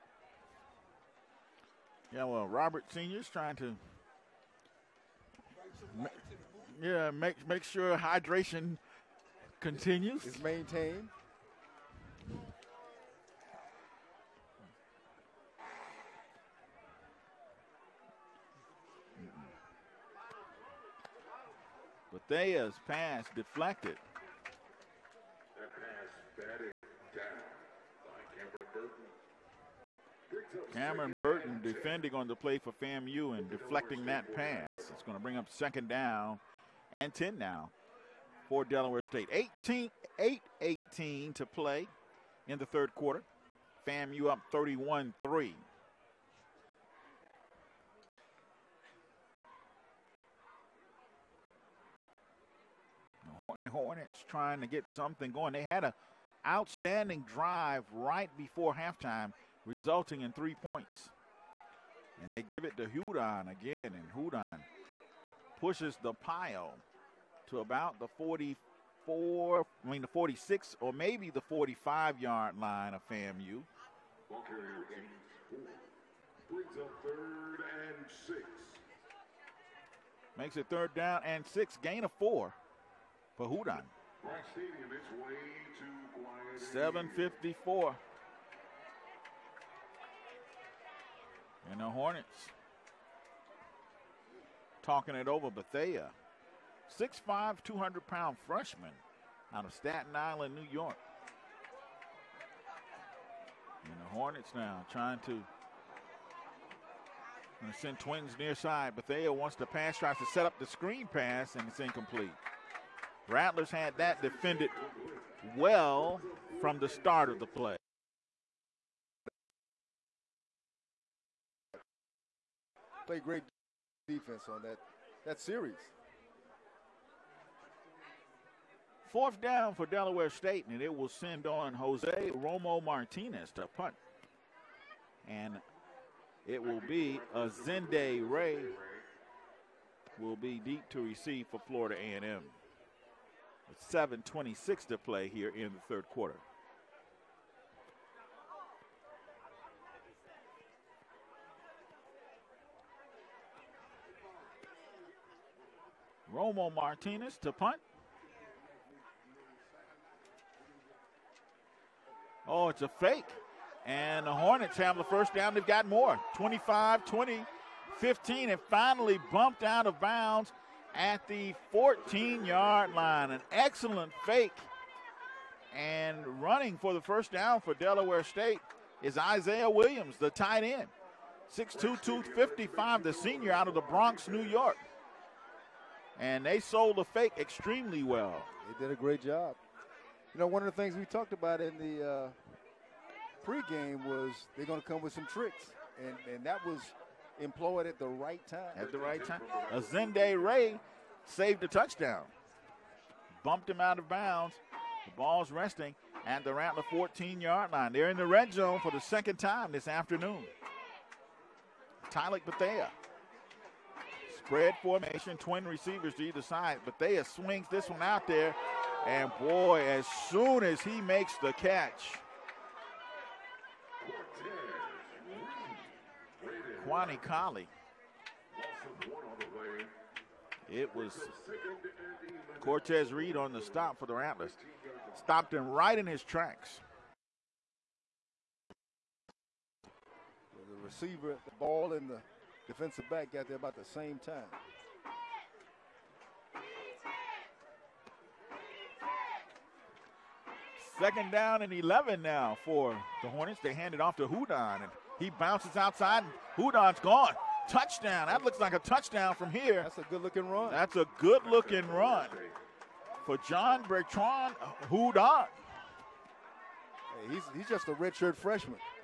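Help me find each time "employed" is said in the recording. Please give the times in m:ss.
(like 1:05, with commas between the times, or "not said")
3:17.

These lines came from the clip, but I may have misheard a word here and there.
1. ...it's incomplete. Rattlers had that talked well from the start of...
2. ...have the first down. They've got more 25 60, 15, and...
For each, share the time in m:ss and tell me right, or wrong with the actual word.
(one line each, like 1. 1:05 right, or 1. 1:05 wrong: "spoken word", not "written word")
1. 1:51 wrong: "defended", not "talked"
2. 2:44 wrong: "20", not "60".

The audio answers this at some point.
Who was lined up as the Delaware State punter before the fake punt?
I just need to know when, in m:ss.
2:11.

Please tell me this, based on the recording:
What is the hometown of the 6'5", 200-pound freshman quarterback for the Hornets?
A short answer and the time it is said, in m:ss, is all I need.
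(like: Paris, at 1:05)
Staten Island, New York, at 1:39.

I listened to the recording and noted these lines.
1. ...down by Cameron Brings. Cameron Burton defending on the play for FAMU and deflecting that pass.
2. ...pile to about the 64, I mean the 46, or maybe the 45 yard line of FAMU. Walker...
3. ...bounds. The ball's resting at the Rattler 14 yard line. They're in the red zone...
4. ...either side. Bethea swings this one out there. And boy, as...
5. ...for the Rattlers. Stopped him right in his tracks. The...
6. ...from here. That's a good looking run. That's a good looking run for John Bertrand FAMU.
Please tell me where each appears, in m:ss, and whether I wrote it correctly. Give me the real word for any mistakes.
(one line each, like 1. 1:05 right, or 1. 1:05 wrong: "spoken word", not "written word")
1. 0:27 wrong: "Burton", not "Brings"
2. 1:06 wrong: "44", not "64"
3. 3:24 right
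4. 3:36 right
5. 3:53 right
6. 4:19 wrong: "Hudon", not "FAMU".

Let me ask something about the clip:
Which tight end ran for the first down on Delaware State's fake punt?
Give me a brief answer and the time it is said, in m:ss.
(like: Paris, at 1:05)
Isaiah Williams, at 2:59.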